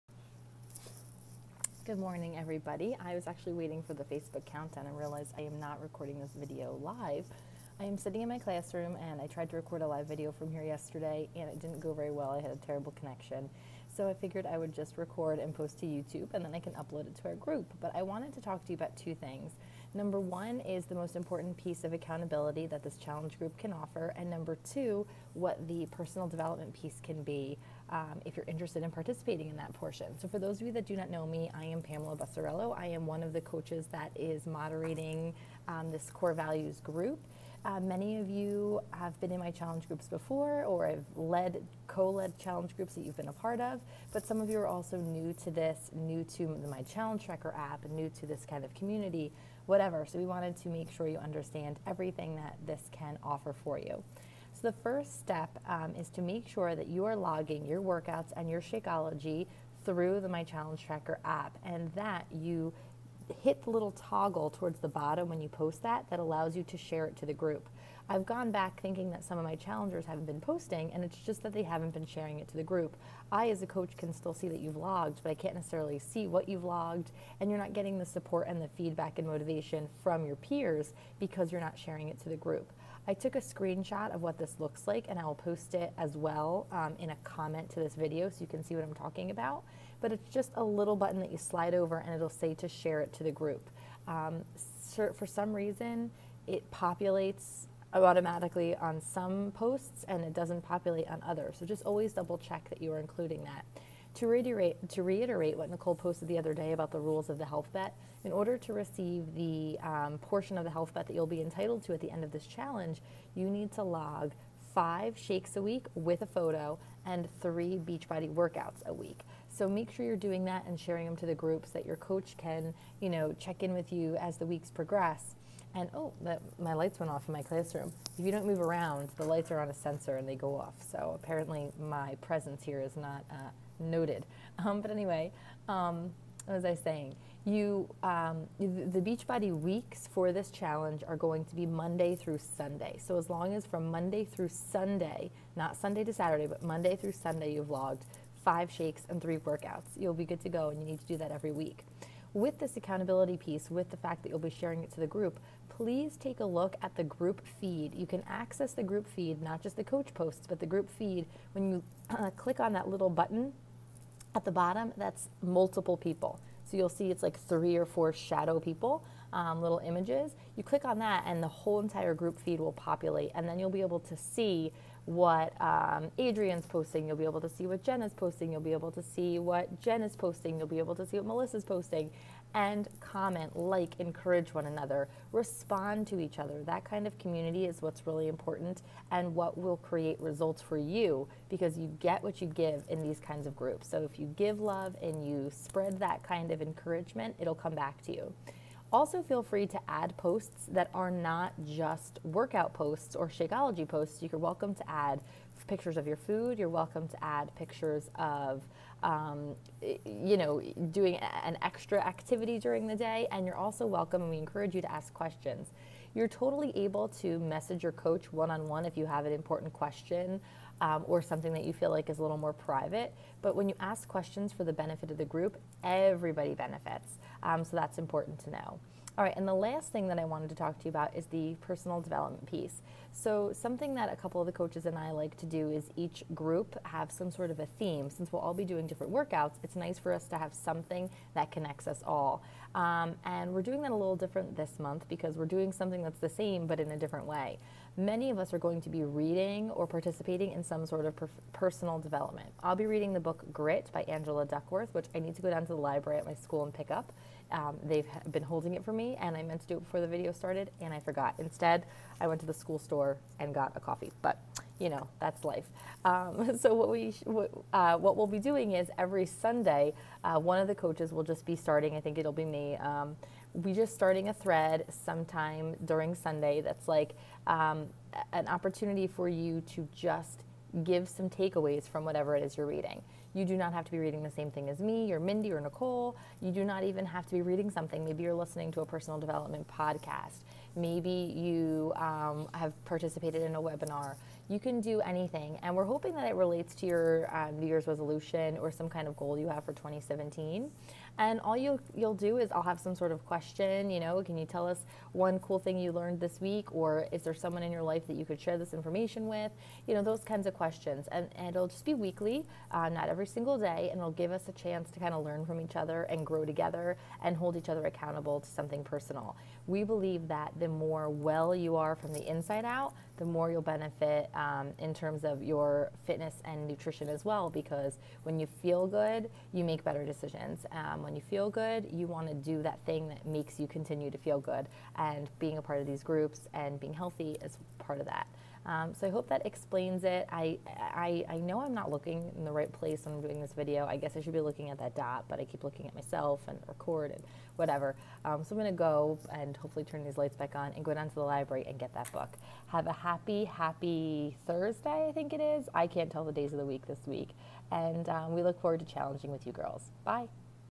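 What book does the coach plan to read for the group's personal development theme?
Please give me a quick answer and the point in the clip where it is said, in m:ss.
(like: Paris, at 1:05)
Grit, at 4:13.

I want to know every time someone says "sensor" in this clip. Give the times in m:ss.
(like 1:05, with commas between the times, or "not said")
2:09.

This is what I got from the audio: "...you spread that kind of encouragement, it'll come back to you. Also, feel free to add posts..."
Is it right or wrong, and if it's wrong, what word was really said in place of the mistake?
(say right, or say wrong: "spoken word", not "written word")
right.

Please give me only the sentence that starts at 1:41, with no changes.
So just always double check that you are including that.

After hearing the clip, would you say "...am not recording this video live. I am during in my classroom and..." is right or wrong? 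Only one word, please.
wrong.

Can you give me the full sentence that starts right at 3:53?
So, something that a couple of the coaches and I like to do is each group have some sort of a theme.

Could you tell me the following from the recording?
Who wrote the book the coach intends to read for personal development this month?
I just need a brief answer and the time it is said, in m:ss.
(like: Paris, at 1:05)
Angela Duckworth, at 4:14.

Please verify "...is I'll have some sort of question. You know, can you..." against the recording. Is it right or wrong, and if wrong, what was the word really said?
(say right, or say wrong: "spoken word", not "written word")
right.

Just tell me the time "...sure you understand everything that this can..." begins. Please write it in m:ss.
0:50.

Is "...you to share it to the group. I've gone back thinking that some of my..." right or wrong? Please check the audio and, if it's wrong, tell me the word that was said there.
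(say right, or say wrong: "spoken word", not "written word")
right.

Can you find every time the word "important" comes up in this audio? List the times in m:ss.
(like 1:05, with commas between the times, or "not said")
0:21, 3:08, 3:39, 3:47.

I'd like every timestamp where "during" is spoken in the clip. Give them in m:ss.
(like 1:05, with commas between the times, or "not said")
3:32, 4:35.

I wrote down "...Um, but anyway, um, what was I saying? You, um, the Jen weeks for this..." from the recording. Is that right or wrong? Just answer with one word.
wrong.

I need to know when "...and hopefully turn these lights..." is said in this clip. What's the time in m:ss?
5:49.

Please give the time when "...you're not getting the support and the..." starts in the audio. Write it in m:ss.
1:17.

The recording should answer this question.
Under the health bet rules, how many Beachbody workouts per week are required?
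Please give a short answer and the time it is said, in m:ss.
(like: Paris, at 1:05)
3, at 1:57.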